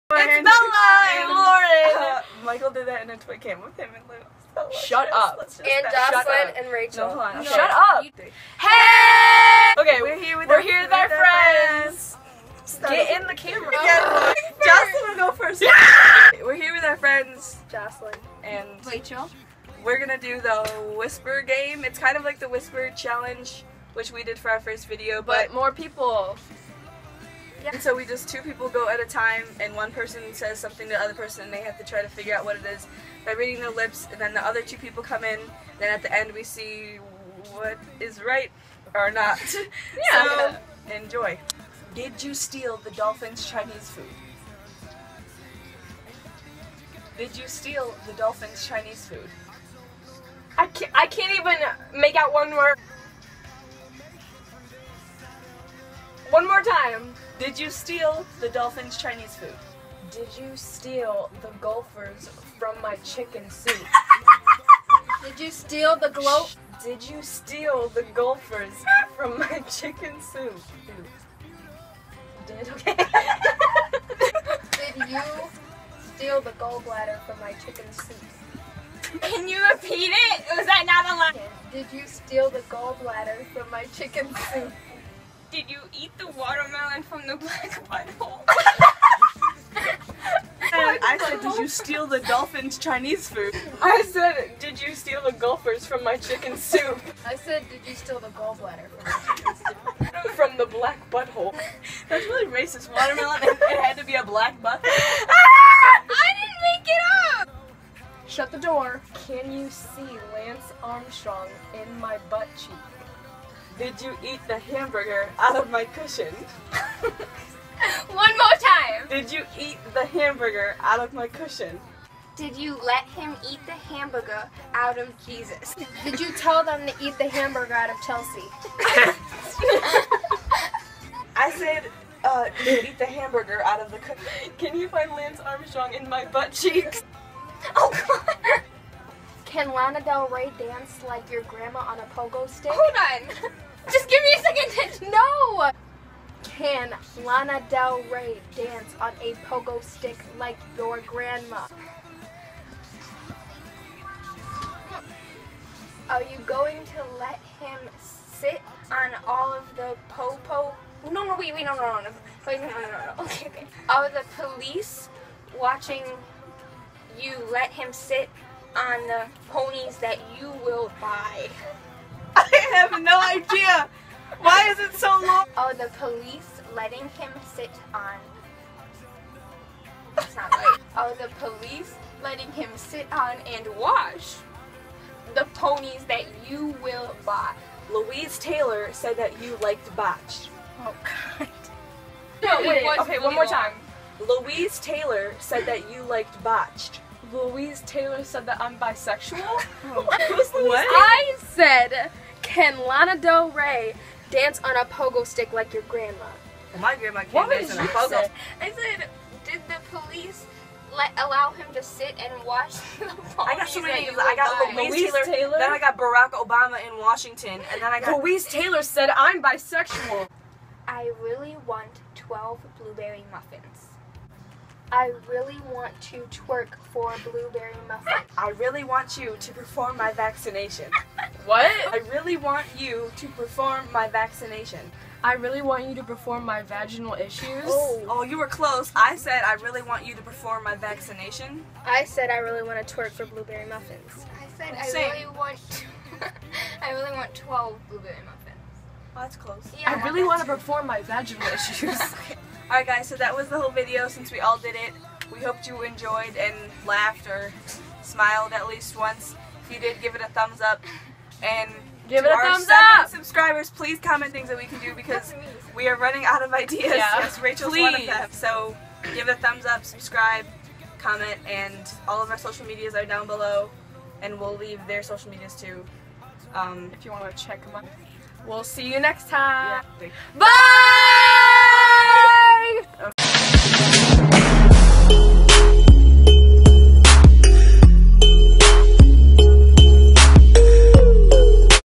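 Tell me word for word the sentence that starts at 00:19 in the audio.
We're gonna do the whisper game.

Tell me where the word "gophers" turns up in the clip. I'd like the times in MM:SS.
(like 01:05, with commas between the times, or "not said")
01:01, 01:08.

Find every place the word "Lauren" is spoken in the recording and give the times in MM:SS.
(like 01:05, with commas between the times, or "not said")
00:01.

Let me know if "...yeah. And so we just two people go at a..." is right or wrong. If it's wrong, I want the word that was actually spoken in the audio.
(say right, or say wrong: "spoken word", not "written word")
right.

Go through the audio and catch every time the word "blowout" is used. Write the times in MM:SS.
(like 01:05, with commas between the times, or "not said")
not said.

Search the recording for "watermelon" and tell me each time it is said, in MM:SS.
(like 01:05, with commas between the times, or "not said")
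01:26, 01:42.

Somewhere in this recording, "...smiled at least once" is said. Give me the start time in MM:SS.
04:18.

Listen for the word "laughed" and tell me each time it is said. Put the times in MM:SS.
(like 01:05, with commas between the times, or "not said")
04:16.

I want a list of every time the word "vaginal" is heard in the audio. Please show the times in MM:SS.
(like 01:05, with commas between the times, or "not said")
03:56, 04:11.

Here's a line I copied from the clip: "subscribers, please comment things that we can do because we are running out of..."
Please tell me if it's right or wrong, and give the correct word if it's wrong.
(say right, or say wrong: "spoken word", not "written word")
right.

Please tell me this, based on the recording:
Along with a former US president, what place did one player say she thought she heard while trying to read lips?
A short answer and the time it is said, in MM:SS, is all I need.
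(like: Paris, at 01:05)
Washington, at 03:36.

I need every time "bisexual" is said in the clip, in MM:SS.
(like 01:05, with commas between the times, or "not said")
03:18, 03:39.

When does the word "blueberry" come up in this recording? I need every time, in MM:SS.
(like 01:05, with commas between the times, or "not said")
03:42, 03:47, 04:03, 04:07.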